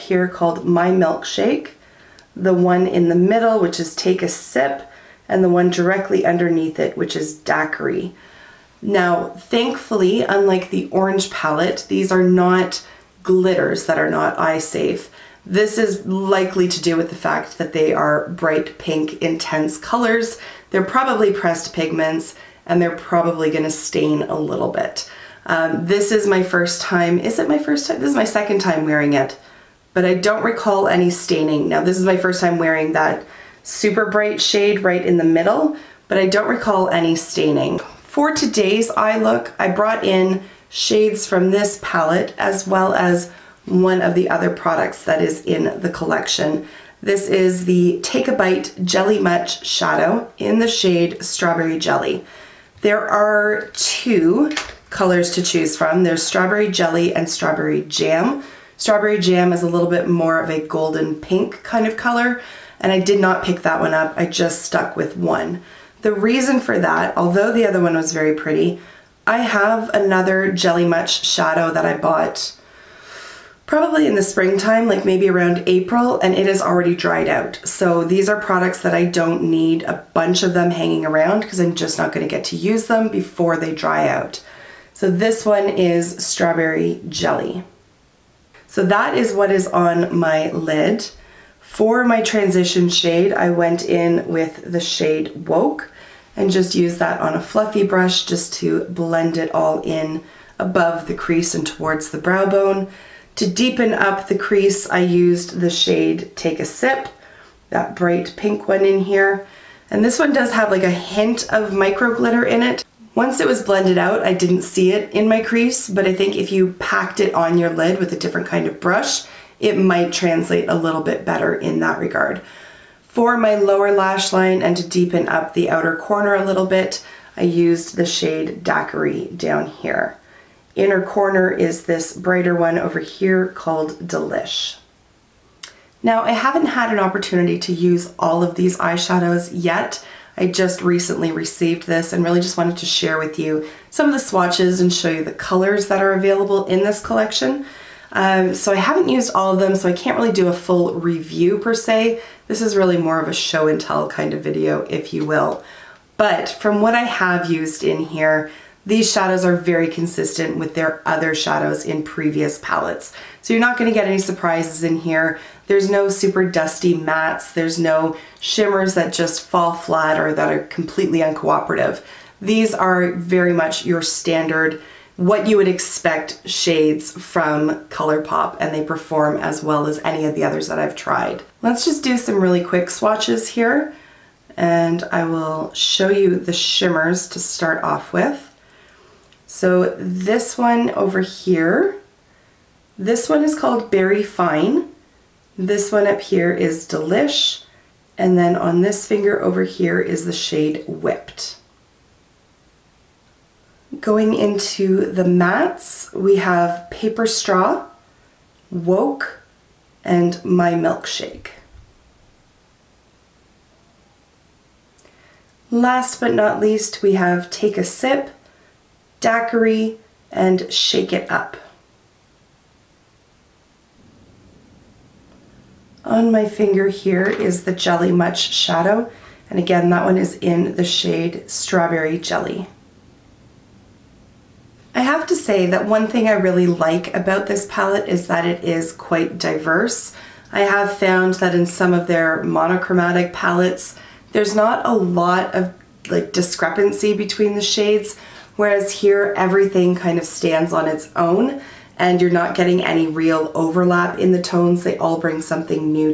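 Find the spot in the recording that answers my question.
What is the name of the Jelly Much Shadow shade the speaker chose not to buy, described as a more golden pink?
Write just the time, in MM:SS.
00:58.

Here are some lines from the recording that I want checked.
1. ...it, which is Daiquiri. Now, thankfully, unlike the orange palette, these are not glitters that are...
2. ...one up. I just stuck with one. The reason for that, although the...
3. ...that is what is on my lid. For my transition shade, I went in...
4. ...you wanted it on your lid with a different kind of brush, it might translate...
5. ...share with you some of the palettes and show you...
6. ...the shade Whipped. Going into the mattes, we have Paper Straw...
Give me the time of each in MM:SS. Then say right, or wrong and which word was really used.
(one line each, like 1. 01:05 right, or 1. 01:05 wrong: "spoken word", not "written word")
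1. 00:06 right
2. 01:03 right
3. 01:28 right
4. 01:56 wrong: "packed", not "wanted"
5. 02:22 wrong: "swatches", not "palettes"
6. 03:20 right.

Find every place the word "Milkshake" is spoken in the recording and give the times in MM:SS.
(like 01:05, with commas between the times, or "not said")
00:00, 03:30.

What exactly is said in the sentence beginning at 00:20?
They're probably pressed pigments and they're probably gonna stain a little bit.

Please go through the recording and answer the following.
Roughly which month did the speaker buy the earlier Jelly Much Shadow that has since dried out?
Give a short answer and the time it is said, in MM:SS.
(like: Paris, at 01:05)
April, at 01:15.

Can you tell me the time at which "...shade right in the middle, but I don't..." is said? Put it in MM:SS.
00:34.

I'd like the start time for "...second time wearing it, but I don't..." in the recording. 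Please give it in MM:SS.
00:28.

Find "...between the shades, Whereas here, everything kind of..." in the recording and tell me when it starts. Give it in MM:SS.
04:07.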